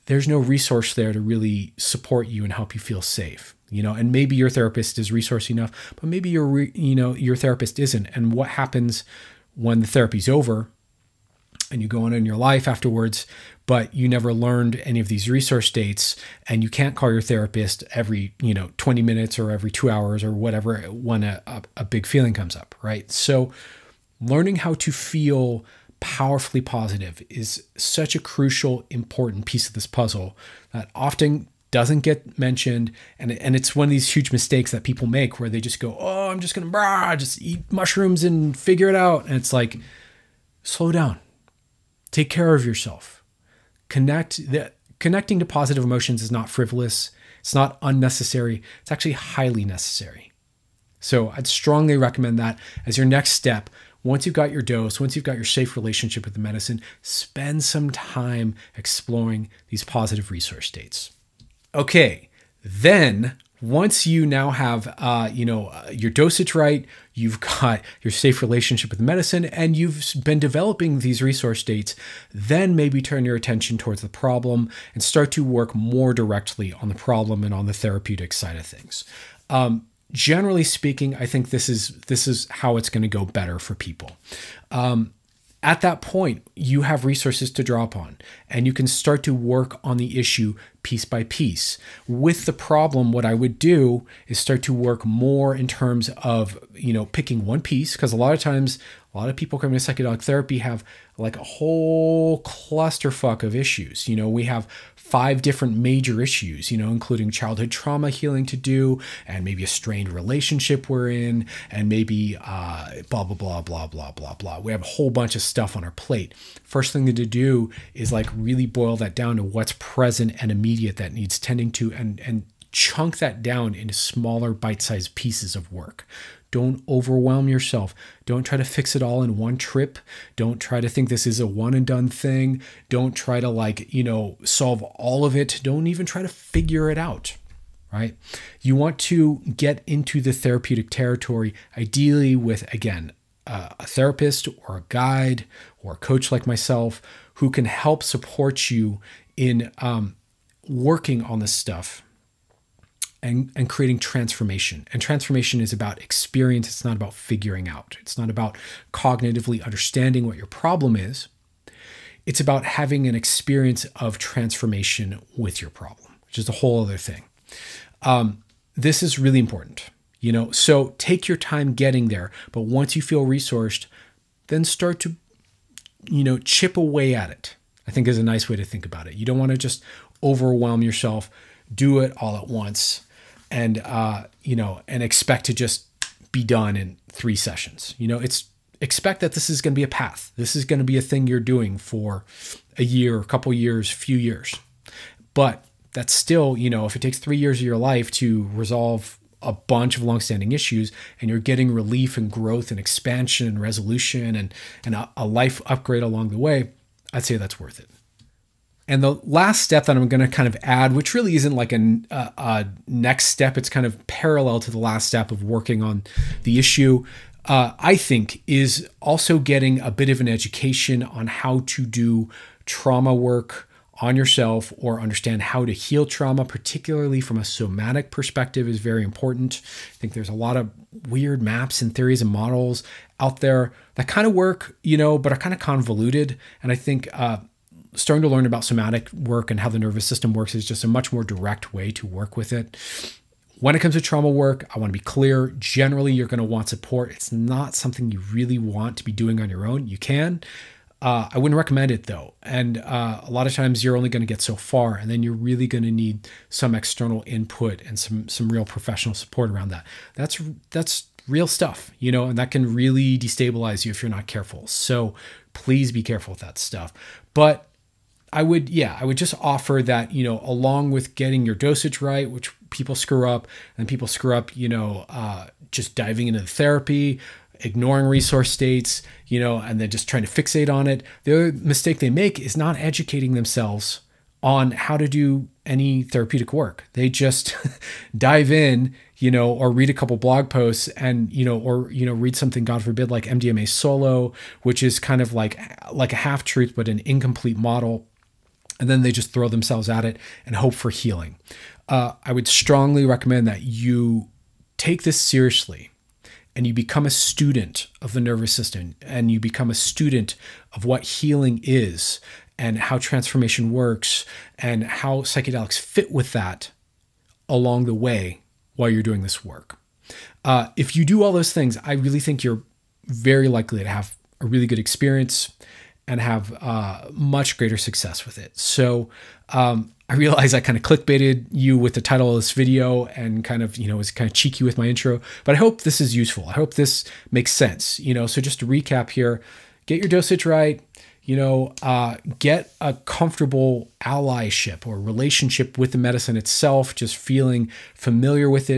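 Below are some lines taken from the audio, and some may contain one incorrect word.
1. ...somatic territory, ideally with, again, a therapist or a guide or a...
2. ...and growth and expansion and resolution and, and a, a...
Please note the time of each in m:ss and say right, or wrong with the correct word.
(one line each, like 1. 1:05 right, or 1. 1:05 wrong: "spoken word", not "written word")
1. 2:20 wrong: "therapeutic", not "somatic"
2. 3:22 right.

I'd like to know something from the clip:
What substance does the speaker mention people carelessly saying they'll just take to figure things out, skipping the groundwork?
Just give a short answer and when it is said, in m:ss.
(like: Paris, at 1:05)
mushrooms, at 0:37.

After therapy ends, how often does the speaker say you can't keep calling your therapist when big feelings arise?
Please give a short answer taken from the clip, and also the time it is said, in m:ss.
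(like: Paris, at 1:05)
20 minutes, at 0:18.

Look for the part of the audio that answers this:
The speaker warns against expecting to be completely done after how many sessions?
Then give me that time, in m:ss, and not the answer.
3:07.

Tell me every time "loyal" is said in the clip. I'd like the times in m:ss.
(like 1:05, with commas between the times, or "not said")
not said.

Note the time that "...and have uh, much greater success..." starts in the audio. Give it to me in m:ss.
5:26.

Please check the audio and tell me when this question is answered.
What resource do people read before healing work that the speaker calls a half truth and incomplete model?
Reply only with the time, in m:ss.
4:53.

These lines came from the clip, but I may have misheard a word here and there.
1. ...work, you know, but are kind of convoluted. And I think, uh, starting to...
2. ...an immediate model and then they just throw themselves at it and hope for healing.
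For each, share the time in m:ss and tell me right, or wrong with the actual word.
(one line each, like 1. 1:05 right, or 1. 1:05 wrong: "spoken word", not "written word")
1. 3:54 right
2. 4:56 wrong: "incomplete", not "immediate".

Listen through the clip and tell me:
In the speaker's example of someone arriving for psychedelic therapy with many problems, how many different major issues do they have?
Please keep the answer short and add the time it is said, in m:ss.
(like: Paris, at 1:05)
5, at 1:44.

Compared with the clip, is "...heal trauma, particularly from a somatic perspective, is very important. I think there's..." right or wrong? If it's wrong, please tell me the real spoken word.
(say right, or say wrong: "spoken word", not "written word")
right.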